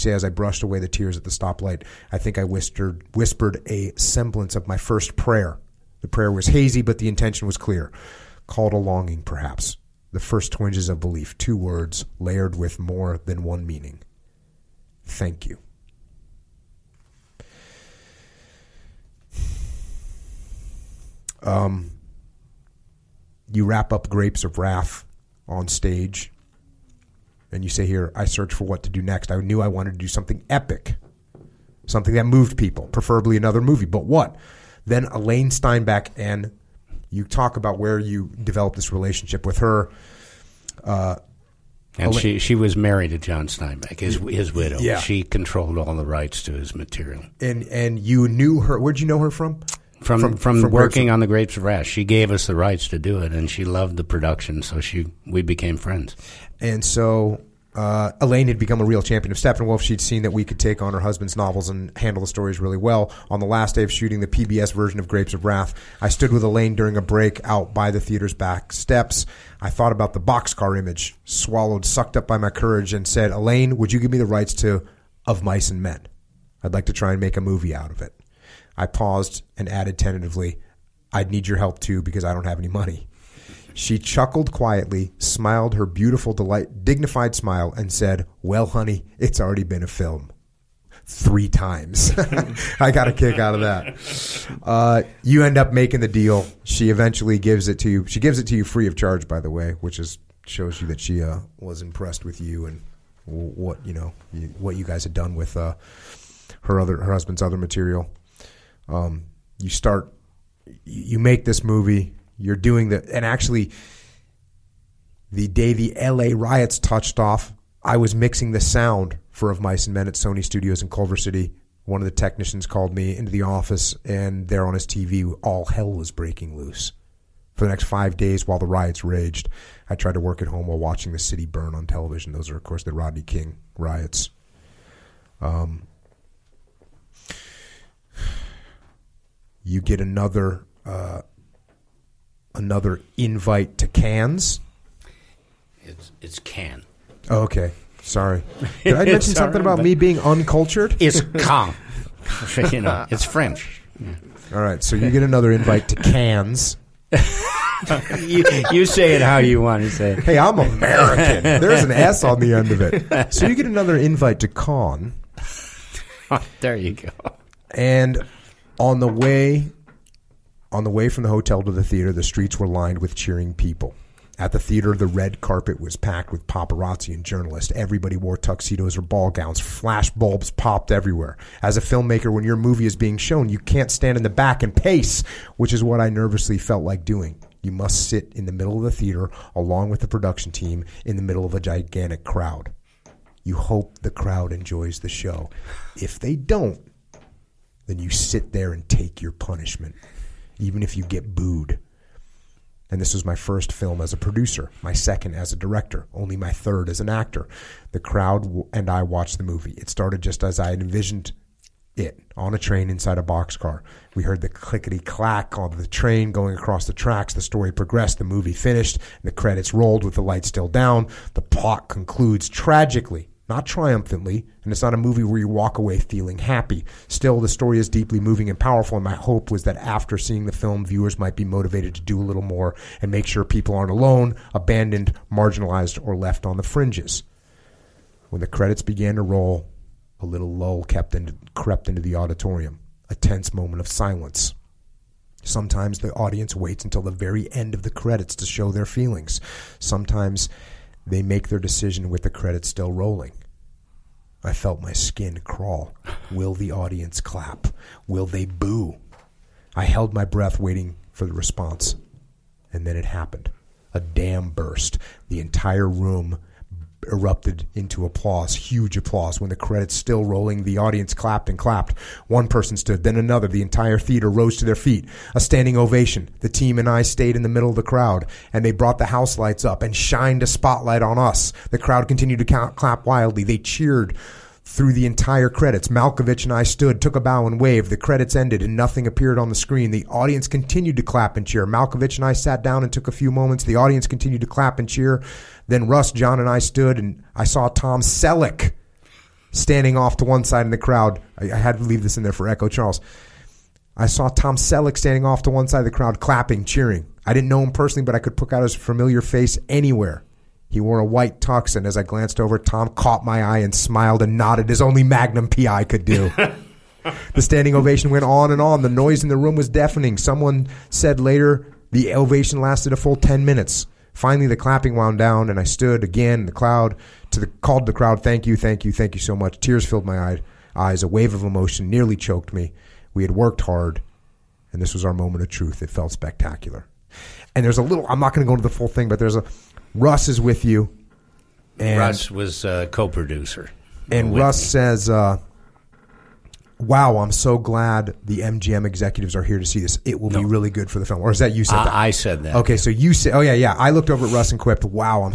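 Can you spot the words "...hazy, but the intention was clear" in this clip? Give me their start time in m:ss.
0:06.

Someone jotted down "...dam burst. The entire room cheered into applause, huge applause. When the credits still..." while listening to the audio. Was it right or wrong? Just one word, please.
wrong.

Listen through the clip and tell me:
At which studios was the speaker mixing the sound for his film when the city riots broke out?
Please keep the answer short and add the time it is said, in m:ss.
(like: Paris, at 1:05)
Sony Studios, at 2:00.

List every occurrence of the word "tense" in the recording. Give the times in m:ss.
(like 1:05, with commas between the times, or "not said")
4:03.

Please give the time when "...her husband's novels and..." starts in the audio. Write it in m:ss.
1:00.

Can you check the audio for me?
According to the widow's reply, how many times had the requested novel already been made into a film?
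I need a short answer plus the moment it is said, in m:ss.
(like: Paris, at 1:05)
3, at 1:31.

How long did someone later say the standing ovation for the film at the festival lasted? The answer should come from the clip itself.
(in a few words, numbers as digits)
10 minutes.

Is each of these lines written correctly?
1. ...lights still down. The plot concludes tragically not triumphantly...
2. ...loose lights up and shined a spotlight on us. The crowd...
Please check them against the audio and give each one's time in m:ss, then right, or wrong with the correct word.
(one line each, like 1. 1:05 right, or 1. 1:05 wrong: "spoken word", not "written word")
1. 3:40 right
2. 4:39 wrong: "house", not "loose".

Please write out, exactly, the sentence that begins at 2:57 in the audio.
Everybody wore tuxedos or ball gowns.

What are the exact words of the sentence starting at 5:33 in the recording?
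We had worked hard, and this was our moment of truth.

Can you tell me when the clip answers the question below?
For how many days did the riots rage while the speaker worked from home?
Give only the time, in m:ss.
2:07.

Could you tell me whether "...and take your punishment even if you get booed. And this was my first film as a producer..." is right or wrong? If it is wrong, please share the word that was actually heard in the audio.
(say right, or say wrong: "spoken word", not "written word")
right.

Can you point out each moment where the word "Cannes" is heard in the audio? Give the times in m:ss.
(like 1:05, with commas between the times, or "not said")
2:23, 2:35.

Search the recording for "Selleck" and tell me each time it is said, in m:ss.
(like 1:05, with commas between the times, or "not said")
4:58, 5:04.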